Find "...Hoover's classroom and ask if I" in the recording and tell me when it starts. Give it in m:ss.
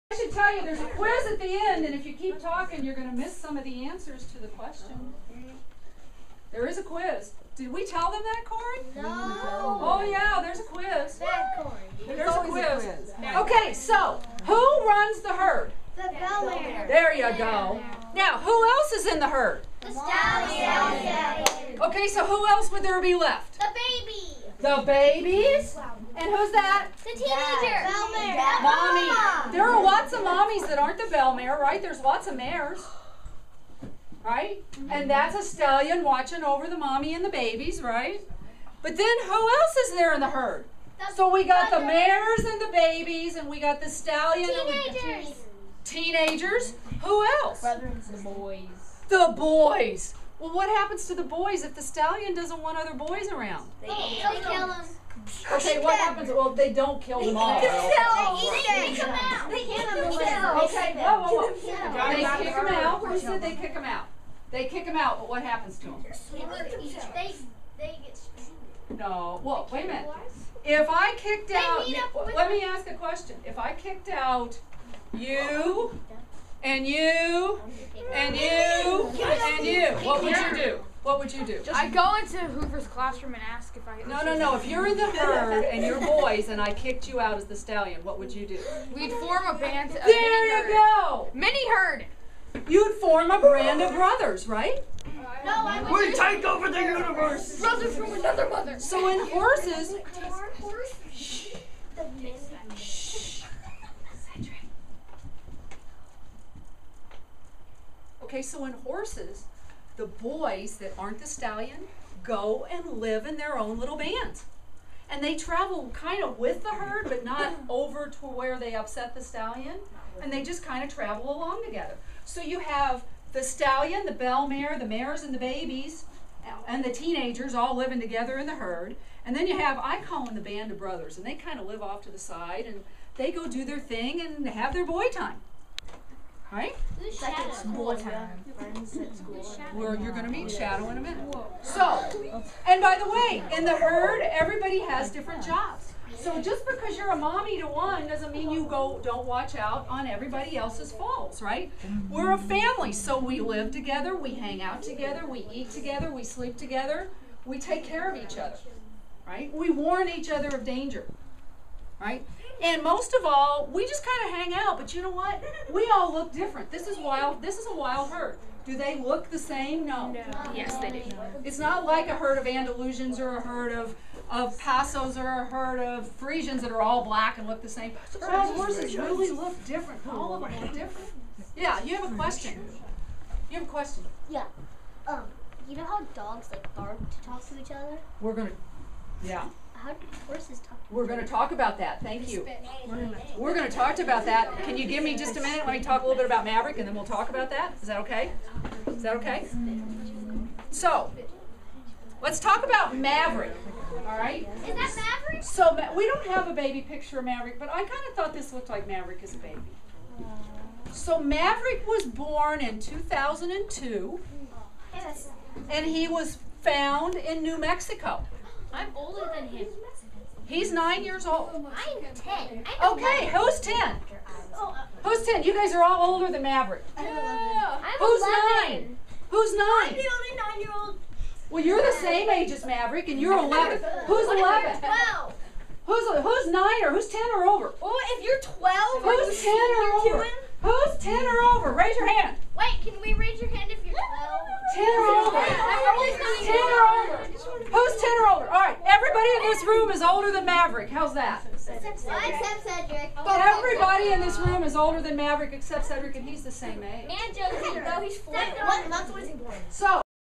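1:22.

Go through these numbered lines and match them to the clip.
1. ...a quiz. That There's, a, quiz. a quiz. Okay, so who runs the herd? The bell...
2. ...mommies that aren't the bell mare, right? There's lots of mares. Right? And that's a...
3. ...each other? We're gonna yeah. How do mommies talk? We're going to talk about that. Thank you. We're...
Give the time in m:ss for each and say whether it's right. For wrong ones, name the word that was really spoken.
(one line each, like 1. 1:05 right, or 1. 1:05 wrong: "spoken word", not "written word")
1. 0:10 right
2. 0:30 right
3. 3:07 wrong: "horses", not "mommies".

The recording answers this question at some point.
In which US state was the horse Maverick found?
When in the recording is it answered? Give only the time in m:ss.
3:37.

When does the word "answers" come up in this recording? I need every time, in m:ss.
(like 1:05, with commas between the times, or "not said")
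0:03.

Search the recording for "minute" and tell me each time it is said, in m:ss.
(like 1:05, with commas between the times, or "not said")
1:09, 2:21, 3:15.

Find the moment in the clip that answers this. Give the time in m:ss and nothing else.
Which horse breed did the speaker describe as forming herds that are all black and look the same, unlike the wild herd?
2:56.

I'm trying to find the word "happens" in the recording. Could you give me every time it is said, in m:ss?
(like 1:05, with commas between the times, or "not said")
0:50, 0:55, 1:05.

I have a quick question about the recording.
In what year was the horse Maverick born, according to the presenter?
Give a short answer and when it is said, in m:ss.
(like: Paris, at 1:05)
2002, at 3:32.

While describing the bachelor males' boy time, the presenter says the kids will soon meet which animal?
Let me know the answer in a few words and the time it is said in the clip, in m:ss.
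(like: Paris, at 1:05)
Shadow, at 2:20.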